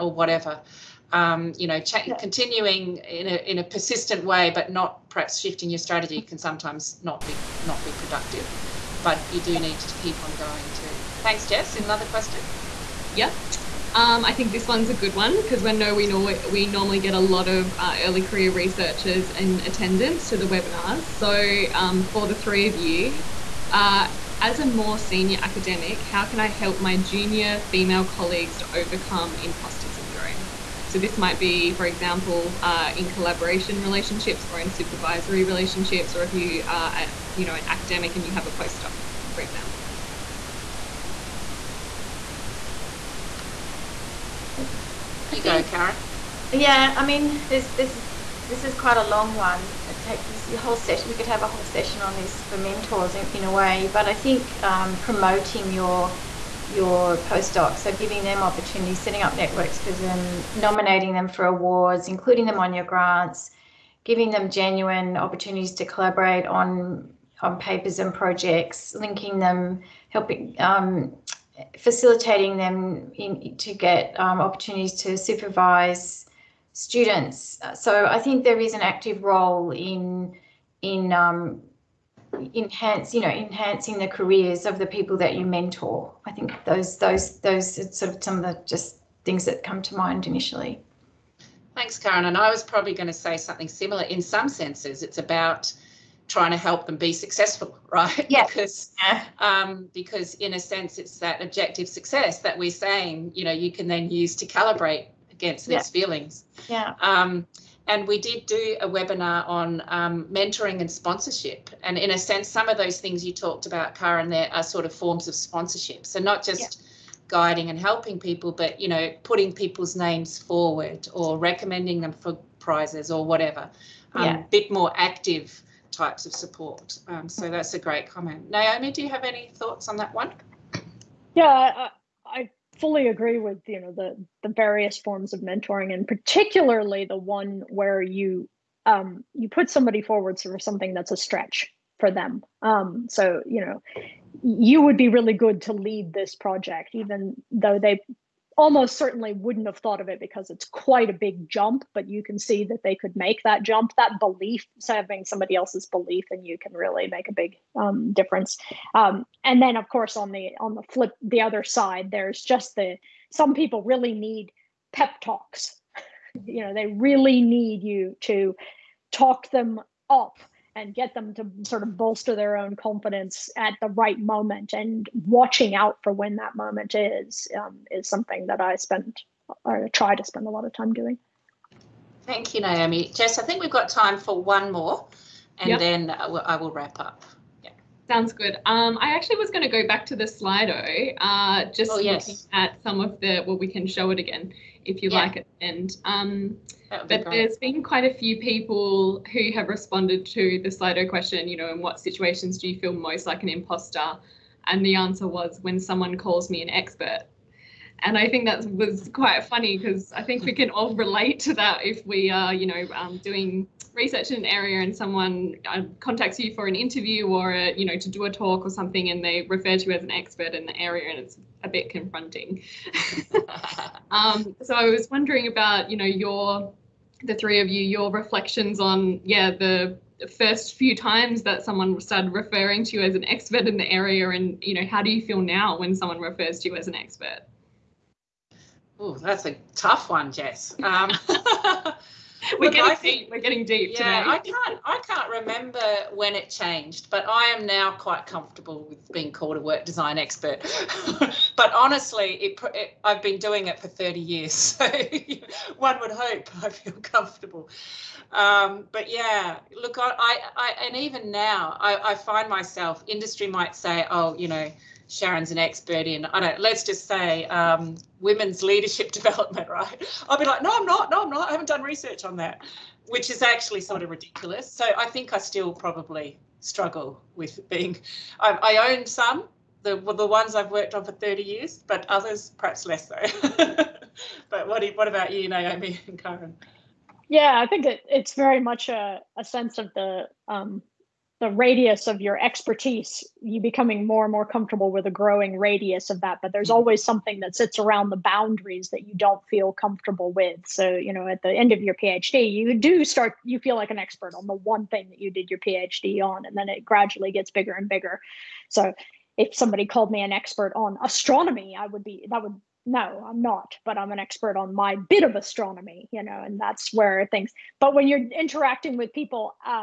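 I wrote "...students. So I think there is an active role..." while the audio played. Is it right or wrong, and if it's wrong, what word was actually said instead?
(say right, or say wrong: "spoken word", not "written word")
right.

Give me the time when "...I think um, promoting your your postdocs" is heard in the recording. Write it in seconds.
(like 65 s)
54 s.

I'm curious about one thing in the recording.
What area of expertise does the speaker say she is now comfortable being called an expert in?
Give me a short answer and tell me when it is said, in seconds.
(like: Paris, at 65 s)
work design, at 249 s.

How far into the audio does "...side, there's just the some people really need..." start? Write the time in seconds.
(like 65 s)
161 s.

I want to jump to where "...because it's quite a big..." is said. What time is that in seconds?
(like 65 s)
150 s.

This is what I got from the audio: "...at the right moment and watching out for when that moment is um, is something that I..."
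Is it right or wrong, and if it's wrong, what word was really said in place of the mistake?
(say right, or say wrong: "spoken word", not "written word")
right.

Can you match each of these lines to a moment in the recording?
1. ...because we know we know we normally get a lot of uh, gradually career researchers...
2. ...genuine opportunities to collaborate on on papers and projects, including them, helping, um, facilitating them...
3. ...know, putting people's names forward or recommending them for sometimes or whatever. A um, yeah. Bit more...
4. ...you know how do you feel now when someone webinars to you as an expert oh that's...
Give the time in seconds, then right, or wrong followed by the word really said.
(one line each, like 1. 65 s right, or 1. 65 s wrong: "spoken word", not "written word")
1. 15 s wrong: "early", not "gradually"
2. 64 s wrong: "linking", not "including"
3. 118 s wrong: "prizes", not "sometimes"
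4. 234 s wrong: "refers", not "webinars".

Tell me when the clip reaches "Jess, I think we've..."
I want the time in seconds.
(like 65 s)
183 s.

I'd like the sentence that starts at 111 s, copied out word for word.
And in a sense, some of those things you talked about, Kaarin, there are sort of forms of sponsorship.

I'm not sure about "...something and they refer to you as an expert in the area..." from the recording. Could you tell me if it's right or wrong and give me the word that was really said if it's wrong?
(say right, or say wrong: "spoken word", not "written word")
right.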